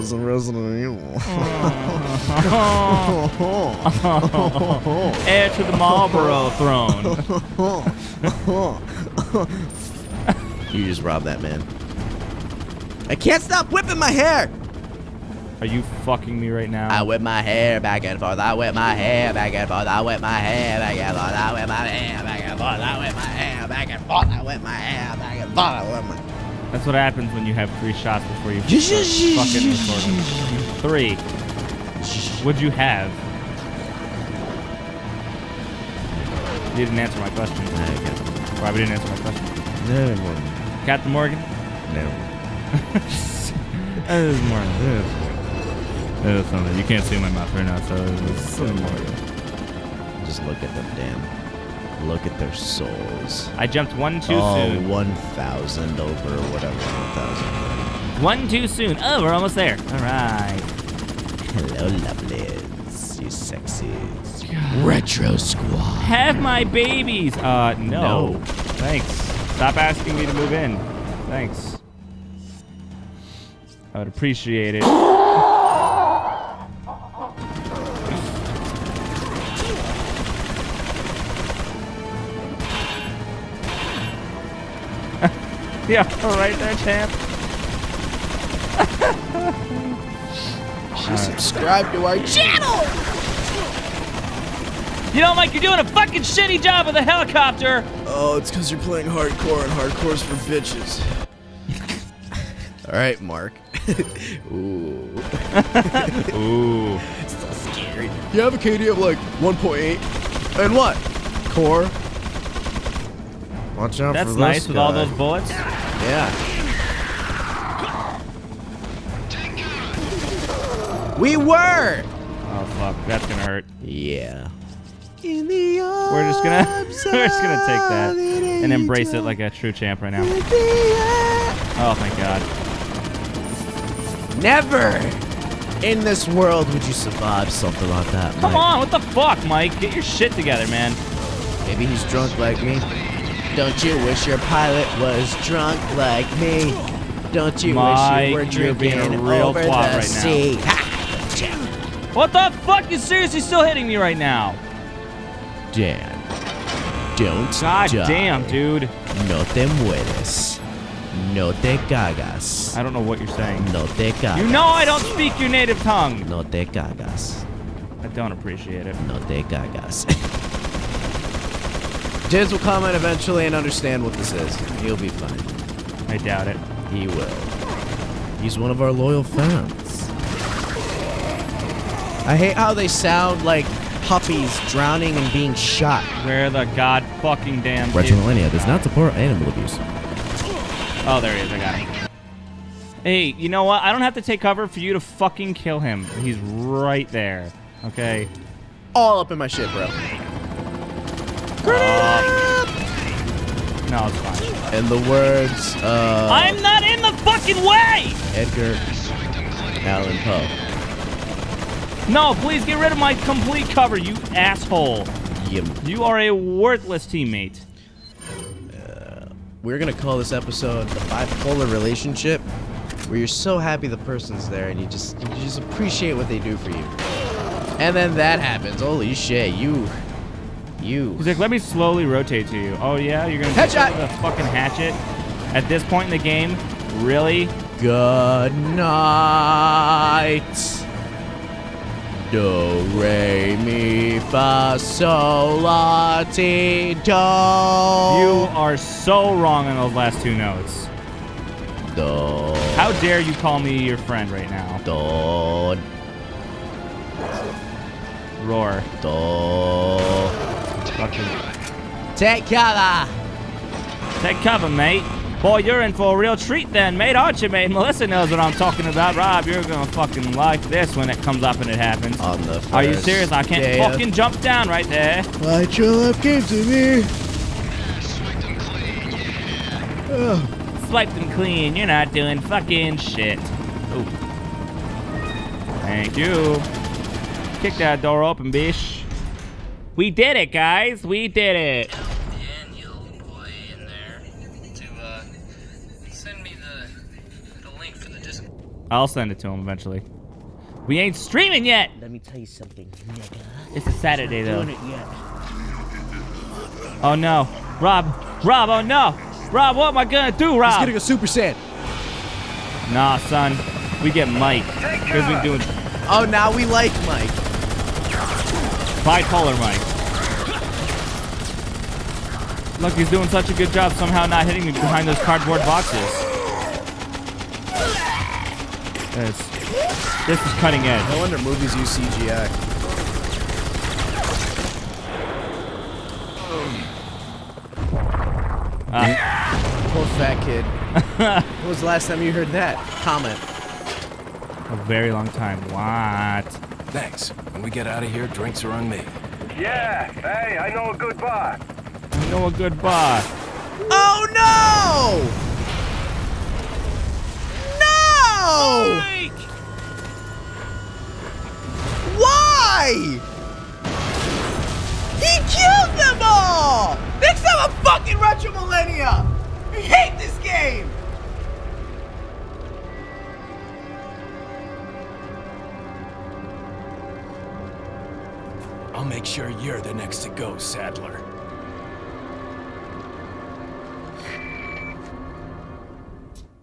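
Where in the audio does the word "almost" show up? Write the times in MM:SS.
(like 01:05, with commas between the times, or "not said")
00:59.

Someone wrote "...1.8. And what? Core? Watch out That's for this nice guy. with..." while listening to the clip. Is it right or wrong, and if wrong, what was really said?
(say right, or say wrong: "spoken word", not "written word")
right.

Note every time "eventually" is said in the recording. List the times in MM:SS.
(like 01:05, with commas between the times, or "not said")
02:52, 04:59.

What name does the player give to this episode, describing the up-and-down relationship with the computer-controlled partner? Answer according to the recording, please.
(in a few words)
the bipolar relationship.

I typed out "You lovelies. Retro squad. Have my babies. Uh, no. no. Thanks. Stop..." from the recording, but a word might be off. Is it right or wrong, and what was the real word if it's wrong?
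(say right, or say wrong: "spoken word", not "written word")
wrong: "sexies", not "lovelies".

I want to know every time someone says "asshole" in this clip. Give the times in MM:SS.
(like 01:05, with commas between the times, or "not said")
03:34.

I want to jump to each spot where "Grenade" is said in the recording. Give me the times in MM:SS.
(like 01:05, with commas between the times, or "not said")
03:21.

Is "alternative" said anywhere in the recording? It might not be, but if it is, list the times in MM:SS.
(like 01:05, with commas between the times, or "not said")
not said.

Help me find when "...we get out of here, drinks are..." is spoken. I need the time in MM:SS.
05:47.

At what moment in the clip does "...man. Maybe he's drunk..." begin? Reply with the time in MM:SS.
02:20.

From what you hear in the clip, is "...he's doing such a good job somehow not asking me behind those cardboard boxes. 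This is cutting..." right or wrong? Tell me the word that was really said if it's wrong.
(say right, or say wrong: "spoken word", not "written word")
wrong: "hitting", not "asking".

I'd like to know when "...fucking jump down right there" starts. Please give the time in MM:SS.
04:33.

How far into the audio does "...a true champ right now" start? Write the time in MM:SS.
02:09.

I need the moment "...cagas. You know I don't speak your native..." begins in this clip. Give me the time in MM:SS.
02:44.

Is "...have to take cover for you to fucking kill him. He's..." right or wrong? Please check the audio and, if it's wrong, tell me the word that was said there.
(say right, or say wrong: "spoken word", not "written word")
right.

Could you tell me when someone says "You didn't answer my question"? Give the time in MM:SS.
00:36.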